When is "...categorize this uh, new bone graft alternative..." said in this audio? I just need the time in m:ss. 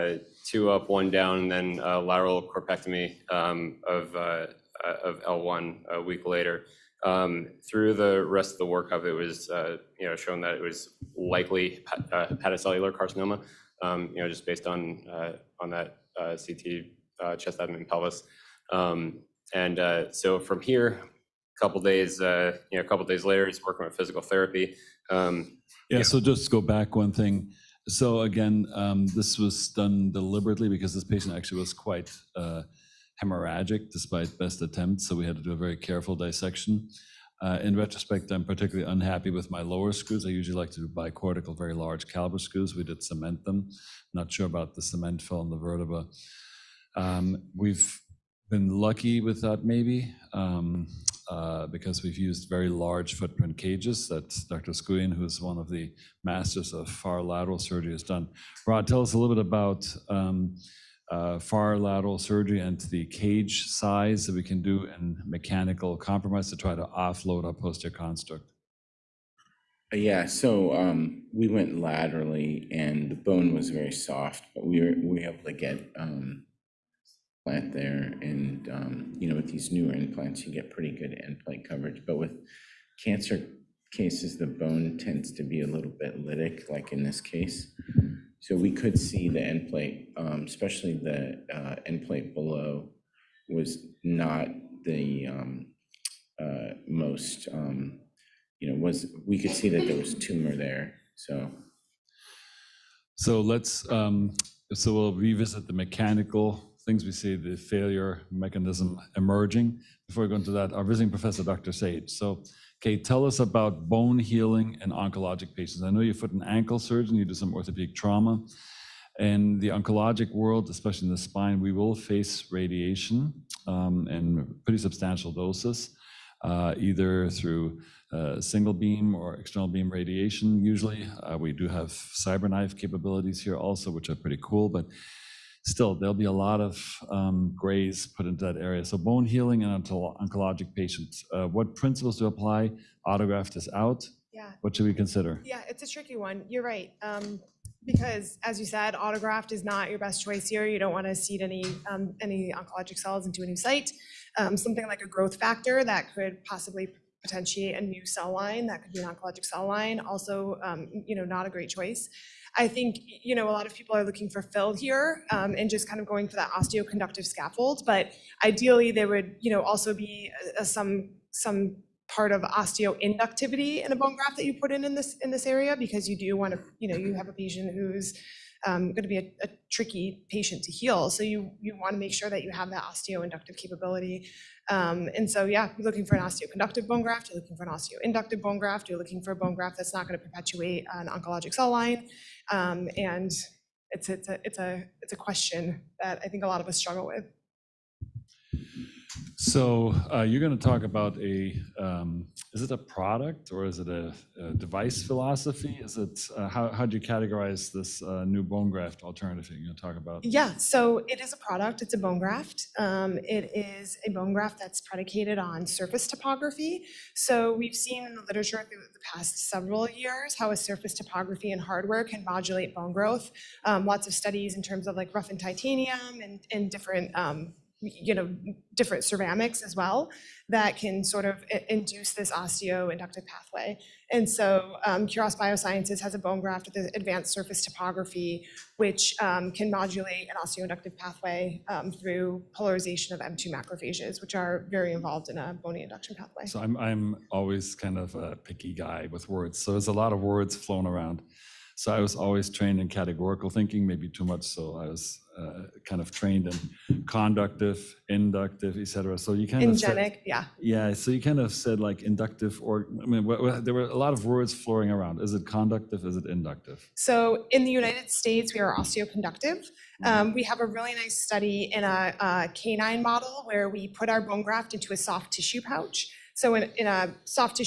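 3:27.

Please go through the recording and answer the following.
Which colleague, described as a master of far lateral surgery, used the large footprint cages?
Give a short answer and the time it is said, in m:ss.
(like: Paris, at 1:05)
Dr. Oskouian, at 0:54.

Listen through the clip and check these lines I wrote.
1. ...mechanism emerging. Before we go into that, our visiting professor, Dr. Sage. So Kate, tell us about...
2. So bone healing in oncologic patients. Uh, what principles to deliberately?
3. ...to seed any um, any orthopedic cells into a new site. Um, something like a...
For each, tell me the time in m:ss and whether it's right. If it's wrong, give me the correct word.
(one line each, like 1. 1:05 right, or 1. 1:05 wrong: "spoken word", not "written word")
1. 1:48 right
2. 2:18 wrong: "apply", not "deliberately"
3. 2:31 wrong: "oncologic", not "orthopedic".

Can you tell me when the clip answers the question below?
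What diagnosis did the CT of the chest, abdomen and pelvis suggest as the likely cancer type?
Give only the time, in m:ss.
0:12.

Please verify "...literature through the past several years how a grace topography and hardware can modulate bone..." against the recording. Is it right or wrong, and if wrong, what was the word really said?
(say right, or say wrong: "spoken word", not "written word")
wrong: "surface", not "grace".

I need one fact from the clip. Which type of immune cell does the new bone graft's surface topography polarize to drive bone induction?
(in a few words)
M2 macrophages.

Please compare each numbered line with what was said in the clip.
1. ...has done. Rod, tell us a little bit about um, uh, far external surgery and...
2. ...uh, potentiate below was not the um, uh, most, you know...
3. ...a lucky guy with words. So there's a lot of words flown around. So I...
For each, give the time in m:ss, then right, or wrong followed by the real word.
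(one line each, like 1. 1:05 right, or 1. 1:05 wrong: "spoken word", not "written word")
1. 0:57 wrong: "lateral", not "external"
2. 1:31 wrong: "endplate", not "potentiate"
3. 4:08 wrong: "picky", not "lucky".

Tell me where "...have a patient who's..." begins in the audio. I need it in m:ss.
2:57.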